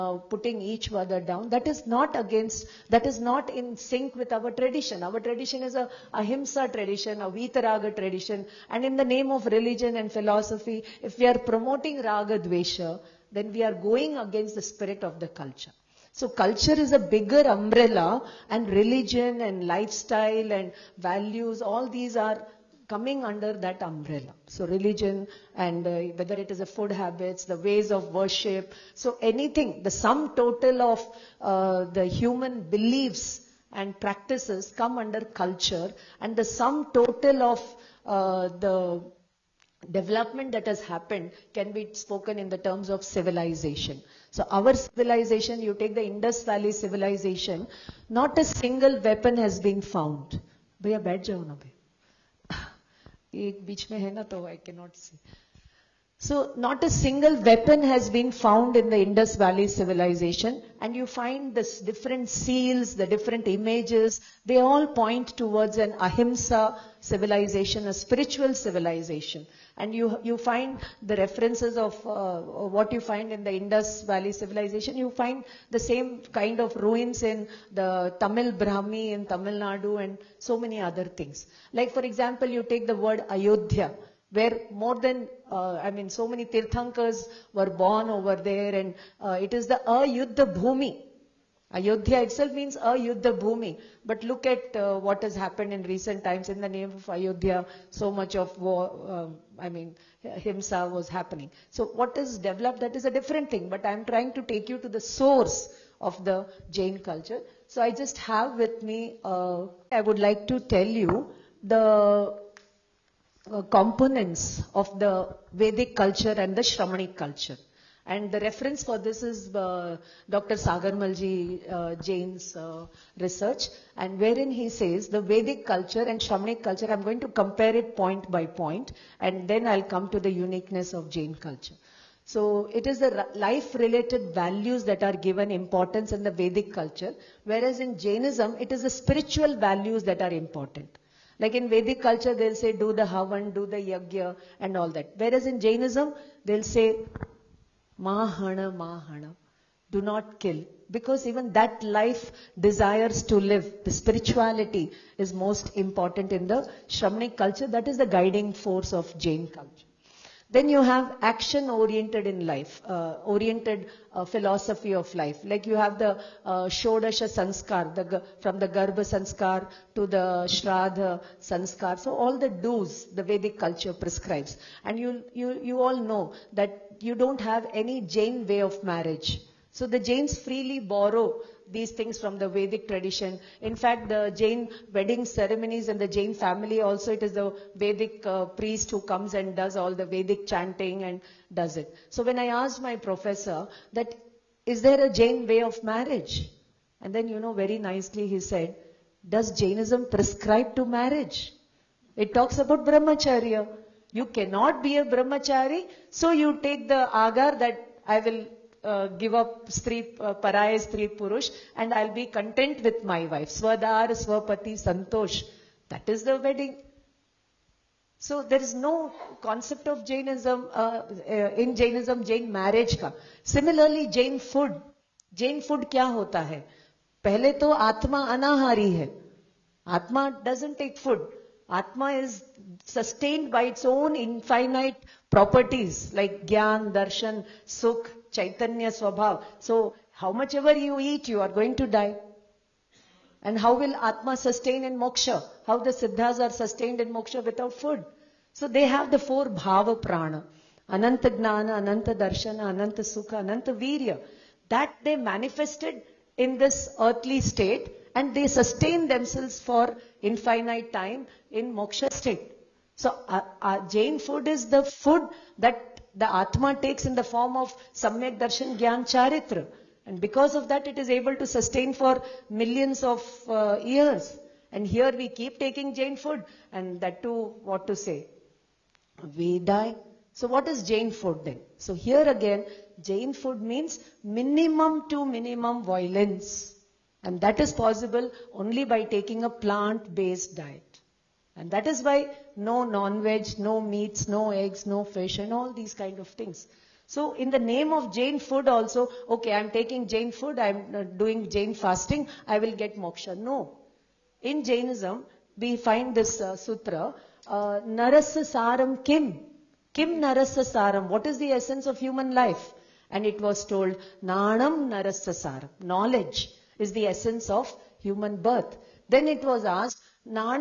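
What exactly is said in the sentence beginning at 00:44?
So our civilization, you take the Indus Valley civilization, not a single weapon has been found.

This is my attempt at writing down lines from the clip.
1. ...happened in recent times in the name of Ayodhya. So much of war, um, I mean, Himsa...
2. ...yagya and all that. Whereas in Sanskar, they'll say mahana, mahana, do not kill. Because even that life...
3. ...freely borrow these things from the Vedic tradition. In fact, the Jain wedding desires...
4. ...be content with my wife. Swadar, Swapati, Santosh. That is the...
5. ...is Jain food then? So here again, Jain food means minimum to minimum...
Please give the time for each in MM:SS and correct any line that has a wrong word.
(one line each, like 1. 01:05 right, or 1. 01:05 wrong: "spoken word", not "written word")
1. 01:35 right
2. 02:23 wrong: "Jainism", not "Sanskar"
3. 03:00 wrong: "ceremonies", not "desires"
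4. 03:32 right
5. 04:40 right.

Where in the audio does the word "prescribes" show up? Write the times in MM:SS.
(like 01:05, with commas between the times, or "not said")
02:53, 03:20.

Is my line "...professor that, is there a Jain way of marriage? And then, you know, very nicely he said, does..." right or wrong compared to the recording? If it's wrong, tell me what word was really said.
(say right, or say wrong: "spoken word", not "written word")
right.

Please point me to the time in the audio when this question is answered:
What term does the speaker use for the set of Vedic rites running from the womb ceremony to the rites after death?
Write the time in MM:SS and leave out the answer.
02:46.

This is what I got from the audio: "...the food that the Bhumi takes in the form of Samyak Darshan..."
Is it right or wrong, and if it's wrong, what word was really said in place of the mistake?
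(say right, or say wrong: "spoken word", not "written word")
wrong: "Atma", not "Bhumi".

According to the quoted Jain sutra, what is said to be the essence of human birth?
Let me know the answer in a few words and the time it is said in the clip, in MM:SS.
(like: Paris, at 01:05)
Knowledge, at 05:15.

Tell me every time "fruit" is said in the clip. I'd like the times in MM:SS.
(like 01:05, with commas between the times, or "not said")
not said.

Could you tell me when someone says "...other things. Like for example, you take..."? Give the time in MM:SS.
01:20.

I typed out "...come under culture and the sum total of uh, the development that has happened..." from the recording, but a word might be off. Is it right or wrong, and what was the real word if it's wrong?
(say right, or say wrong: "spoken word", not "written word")
right.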